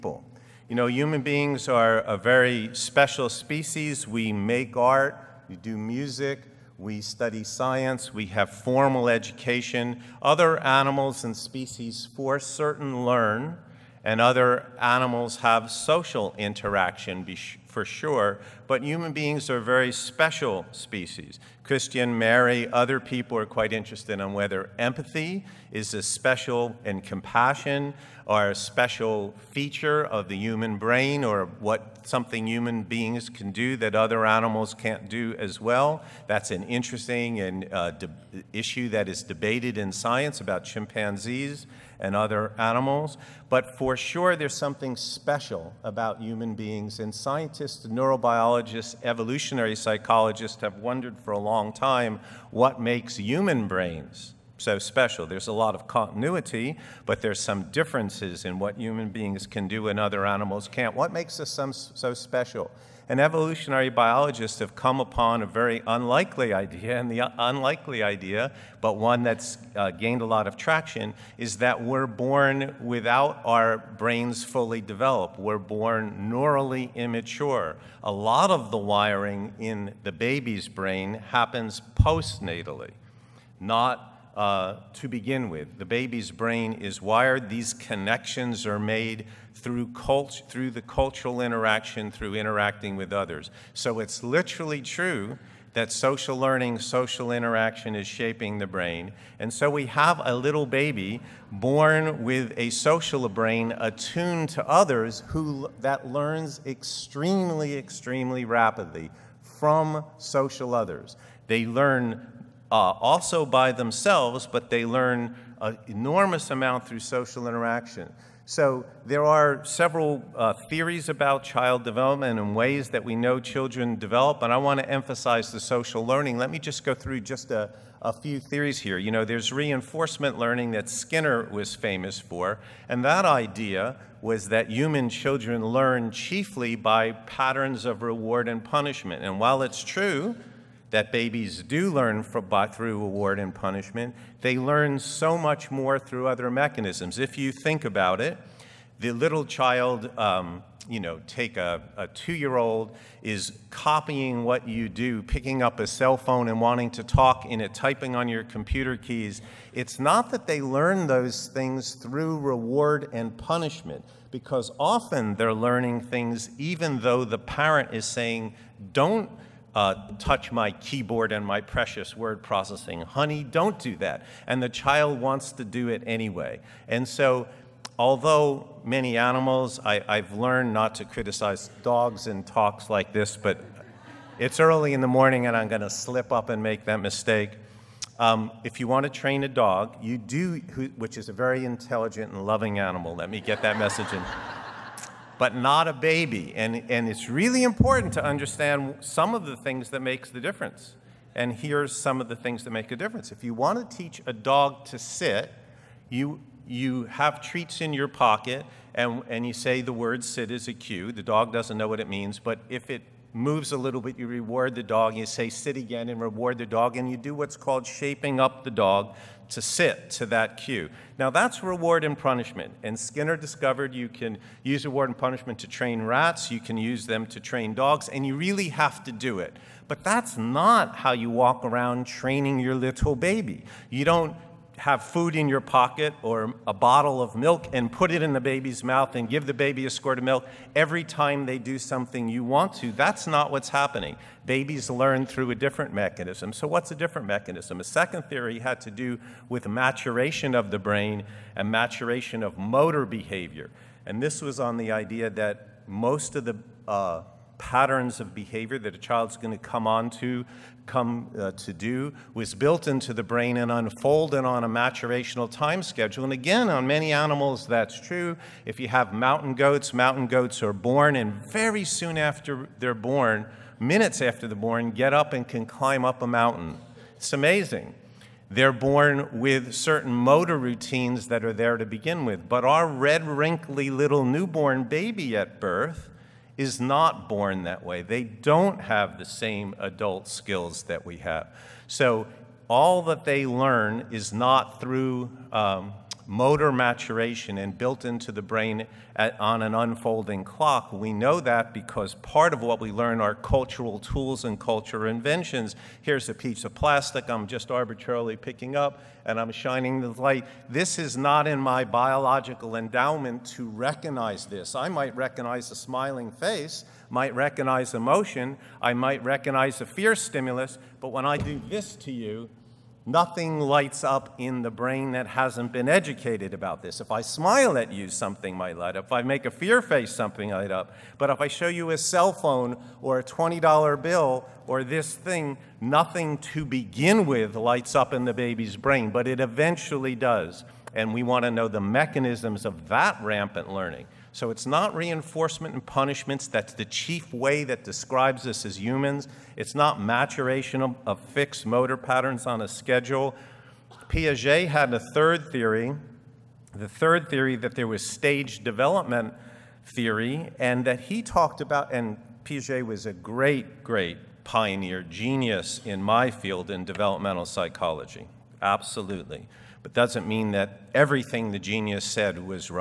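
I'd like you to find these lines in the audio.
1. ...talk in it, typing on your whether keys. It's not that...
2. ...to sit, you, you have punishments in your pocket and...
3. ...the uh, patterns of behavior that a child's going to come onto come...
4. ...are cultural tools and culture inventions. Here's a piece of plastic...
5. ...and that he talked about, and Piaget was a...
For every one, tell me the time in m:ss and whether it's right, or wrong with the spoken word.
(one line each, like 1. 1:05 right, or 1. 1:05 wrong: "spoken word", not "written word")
1. 2:37 wrong: "computer", not "whether"
2. 3:24 wrong: "treats", not "punishments"
3. 4:16 right
4. 5:03 right
5. 6:00 right.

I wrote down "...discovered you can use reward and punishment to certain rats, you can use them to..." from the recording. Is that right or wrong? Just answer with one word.
wrong.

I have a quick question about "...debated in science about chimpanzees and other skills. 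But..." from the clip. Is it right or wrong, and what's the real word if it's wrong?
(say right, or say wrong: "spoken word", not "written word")
wrong: "animals", not "skills".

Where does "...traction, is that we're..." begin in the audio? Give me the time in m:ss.
1:10.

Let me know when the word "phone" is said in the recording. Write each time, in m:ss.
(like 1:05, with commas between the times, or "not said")
2:36, 5:32.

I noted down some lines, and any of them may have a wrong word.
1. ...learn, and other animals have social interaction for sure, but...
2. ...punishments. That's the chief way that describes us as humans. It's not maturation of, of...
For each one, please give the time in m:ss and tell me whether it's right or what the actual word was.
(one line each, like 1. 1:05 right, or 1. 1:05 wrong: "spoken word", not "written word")
1. 0:13 right
2. 5:45 right.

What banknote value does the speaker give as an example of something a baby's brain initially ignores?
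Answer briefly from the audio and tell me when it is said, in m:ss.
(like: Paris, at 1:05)
$20, at 5:33.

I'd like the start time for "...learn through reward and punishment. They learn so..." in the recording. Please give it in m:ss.
2:21.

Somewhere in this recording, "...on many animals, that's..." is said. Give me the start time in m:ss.
4:26.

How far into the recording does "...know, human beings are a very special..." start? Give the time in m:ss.
0:00.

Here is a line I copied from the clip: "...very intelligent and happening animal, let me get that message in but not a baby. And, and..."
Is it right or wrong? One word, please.
wrong.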